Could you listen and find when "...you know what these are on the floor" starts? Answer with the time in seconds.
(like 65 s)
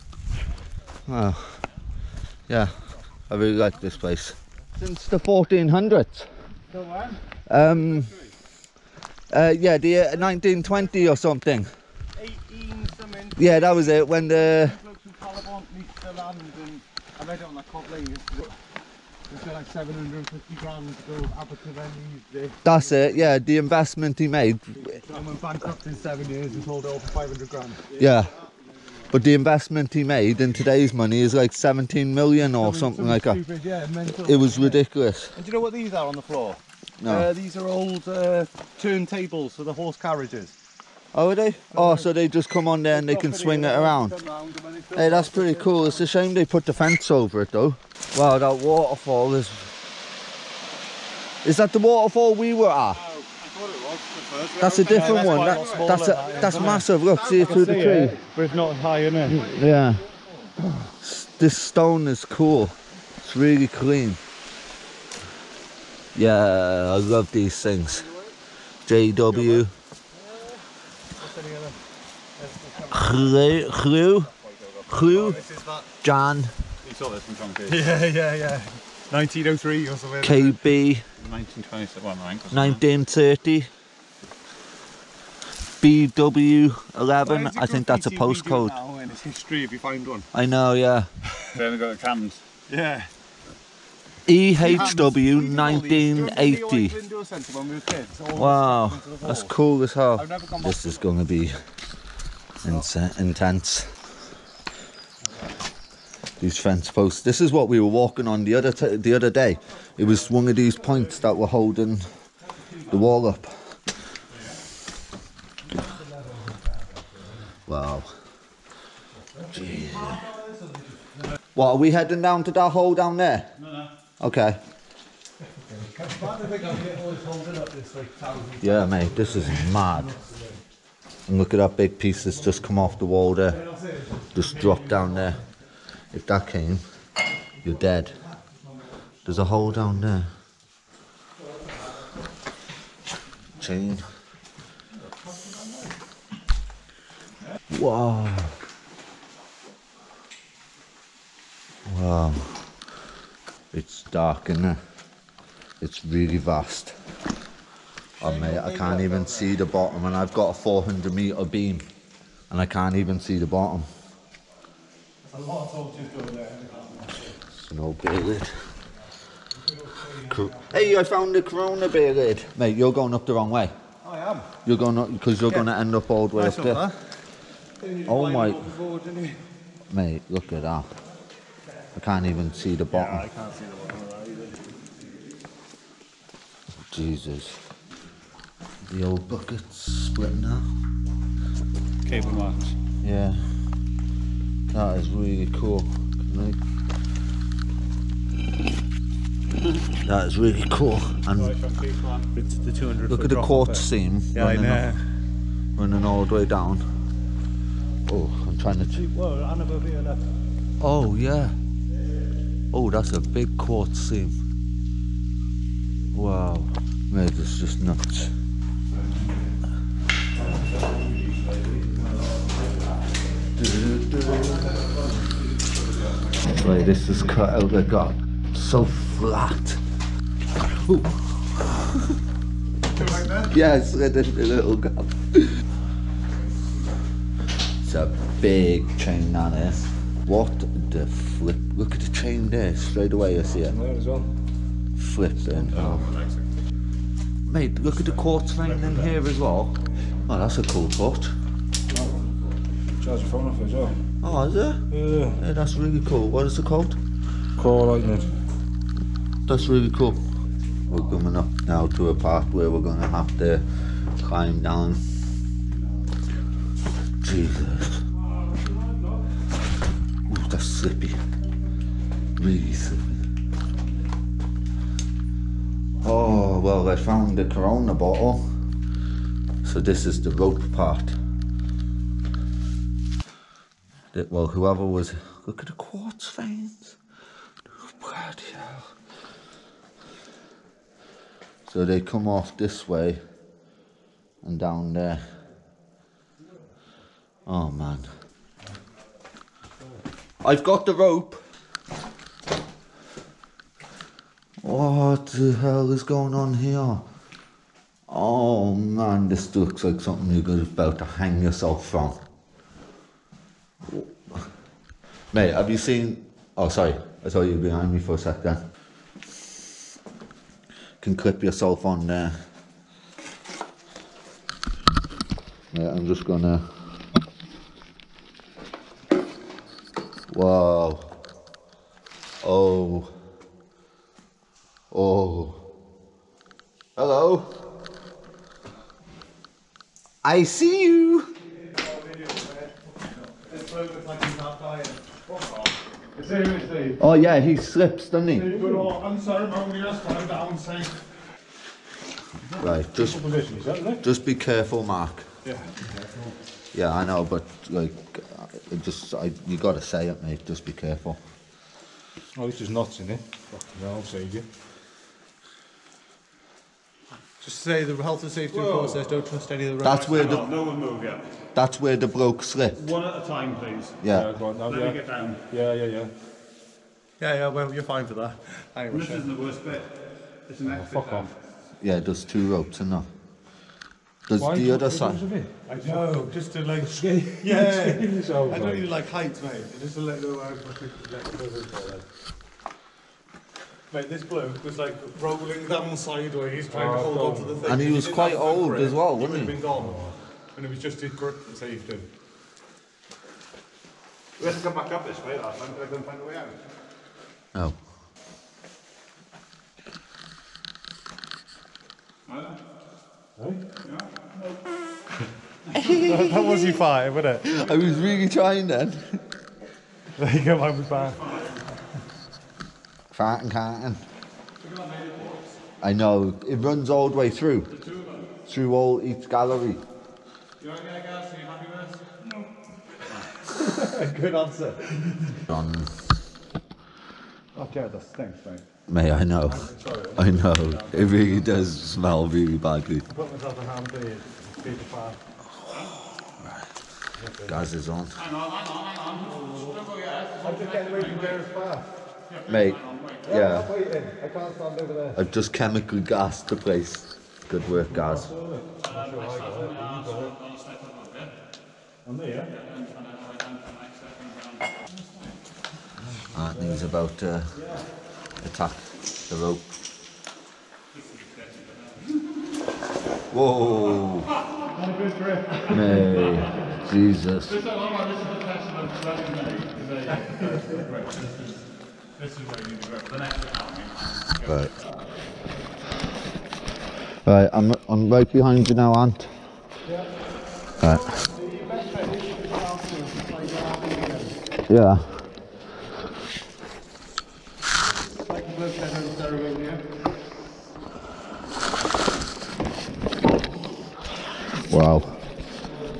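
35 s.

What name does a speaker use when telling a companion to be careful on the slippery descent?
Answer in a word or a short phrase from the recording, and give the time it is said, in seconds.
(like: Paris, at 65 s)
Mark, at 354 s.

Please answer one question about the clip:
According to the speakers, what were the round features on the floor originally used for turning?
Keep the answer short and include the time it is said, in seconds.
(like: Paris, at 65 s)
horse carriages, at 39 s.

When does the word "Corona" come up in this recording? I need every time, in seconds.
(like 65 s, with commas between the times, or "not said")
171 s, 277 s.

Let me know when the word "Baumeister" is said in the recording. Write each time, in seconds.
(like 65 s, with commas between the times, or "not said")
not said.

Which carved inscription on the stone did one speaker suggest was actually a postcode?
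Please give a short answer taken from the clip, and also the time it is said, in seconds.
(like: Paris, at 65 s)
BW11, at 85 s.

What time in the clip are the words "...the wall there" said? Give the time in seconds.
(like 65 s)
132 s.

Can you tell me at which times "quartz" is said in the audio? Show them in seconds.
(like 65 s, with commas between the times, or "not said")
203 s, 213 s, 248 s, 285 s.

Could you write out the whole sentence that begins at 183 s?
Yeah, I can't see the bottom of that either.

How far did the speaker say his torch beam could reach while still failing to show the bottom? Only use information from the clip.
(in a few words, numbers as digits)
400 metres.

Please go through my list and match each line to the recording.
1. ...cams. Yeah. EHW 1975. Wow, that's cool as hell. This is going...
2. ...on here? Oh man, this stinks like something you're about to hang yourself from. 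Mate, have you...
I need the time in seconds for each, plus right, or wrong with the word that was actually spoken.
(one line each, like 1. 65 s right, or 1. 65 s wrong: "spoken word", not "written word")
1. 91 s wrong: "1980", not "1975"
2. 306 s wrong: "looks", not "stinks".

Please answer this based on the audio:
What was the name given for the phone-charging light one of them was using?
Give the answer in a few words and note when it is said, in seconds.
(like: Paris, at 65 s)
Core lightning, at 257 s.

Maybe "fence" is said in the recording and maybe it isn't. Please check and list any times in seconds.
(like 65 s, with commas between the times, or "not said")
46 s, 106 s.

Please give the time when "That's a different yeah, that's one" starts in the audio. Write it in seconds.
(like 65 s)
54 s.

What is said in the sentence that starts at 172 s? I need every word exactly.
Mate, you're going up the wrong way.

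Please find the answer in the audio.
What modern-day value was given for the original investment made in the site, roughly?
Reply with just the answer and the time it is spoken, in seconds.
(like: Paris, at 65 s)
17 million, at 31 s.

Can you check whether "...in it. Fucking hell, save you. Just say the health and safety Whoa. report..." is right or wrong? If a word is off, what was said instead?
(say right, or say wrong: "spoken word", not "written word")
right.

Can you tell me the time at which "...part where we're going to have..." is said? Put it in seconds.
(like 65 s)
262 s.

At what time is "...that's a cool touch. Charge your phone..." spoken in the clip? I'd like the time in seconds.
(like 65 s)
250 s.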